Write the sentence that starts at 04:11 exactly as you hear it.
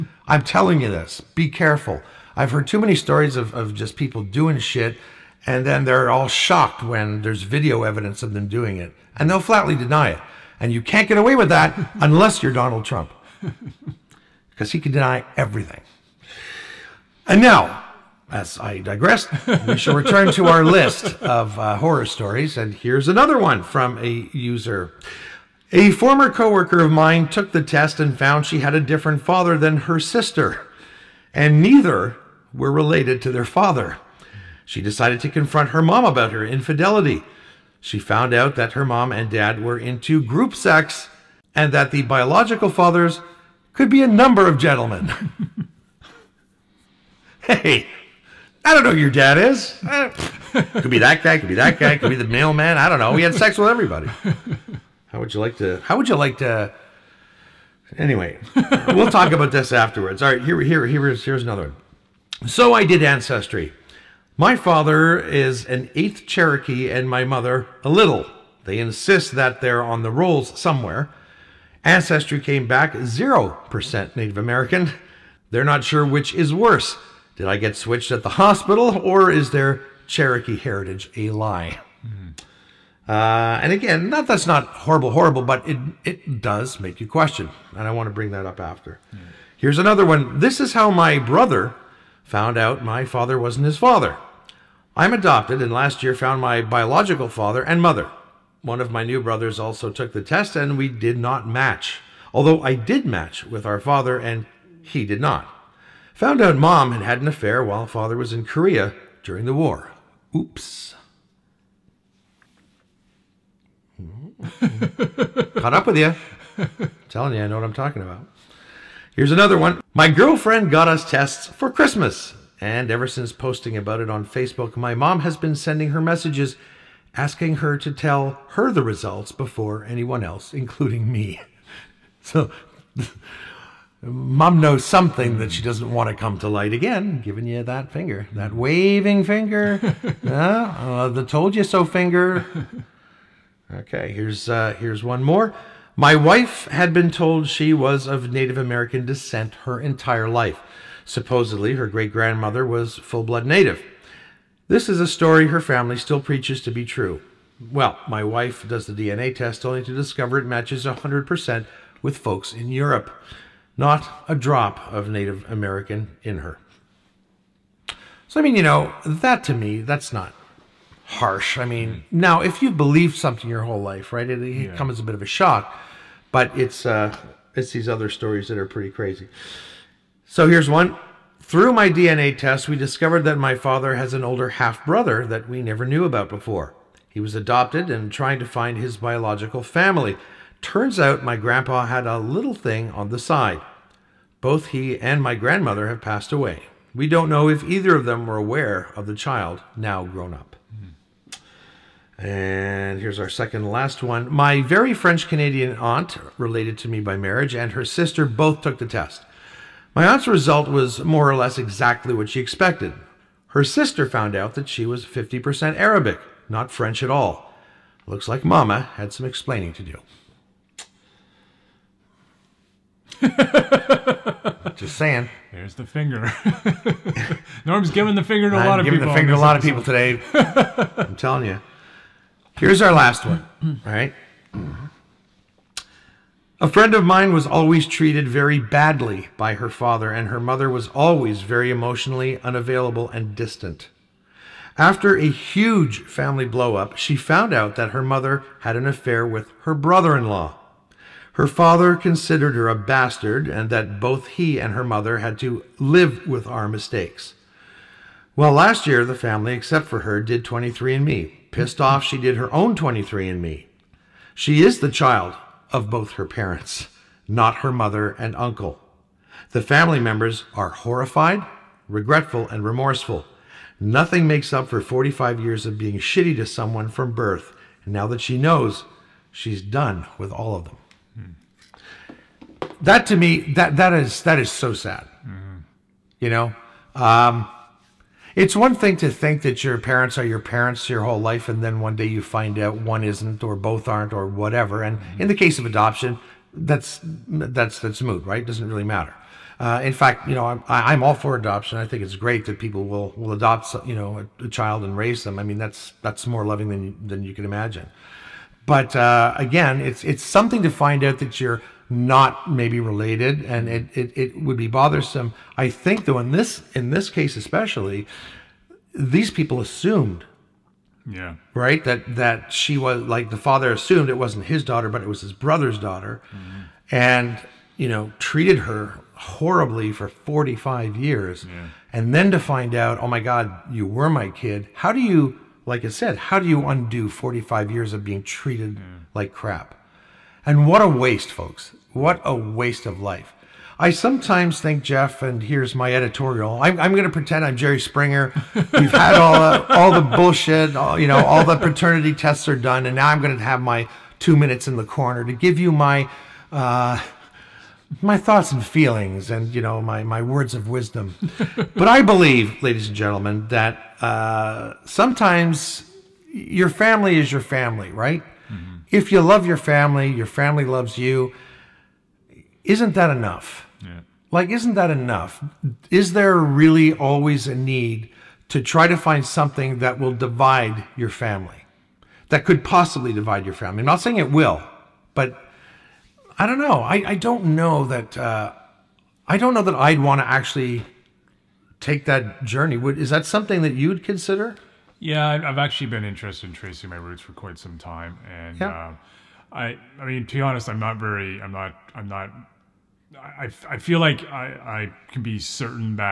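Her father considered her a bastard and that both he and her mother had to live with our mistakes.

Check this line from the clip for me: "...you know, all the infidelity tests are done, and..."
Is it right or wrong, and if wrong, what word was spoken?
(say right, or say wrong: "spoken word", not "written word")
wrong: "paternity", not "infidelity".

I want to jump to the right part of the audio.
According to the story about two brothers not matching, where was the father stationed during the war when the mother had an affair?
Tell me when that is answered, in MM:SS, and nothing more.
01:48.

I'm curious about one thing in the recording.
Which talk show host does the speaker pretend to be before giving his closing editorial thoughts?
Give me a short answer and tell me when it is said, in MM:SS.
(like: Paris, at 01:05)
Jerry Springer, at 05:47.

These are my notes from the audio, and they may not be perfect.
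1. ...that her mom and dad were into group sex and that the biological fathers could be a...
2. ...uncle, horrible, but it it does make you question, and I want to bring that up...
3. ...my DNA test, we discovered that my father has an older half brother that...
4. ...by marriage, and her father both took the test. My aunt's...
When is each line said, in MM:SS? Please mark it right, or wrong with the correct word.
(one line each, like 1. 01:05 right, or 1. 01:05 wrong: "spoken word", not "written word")
1. 00:38 right
2. 01:24 wrong: "horrible", not "uncle"
3. 03:01 right
4. 03:26 wrong: "sister", not "father".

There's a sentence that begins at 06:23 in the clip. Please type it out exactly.
I'm not saying it will, but I don't know.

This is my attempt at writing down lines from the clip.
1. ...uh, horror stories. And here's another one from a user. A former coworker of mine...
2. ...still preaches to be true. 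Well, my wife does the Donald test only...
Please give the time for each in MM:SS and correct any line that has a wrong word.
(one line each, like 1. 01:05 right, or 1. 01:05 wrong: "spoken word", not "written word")
1. 00:21 right
2. 02:35 wrong: "DNA", not "Donald".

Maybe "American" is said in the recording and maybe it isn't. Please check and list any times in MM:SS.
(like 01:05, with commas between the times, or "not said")
01:14, 02:28, 02:45.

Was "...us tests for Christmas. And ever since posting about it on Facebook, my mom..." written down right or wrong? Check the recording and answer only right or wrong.
right.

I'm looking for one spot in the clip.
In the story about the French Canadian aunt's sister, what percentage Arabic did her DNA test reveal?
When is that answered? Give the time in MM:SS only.
03:35.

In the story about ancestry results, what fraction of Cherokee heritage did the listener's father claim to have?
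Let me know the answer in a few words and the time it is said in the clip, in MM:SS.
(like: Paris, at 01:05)
1/8, at 01:05.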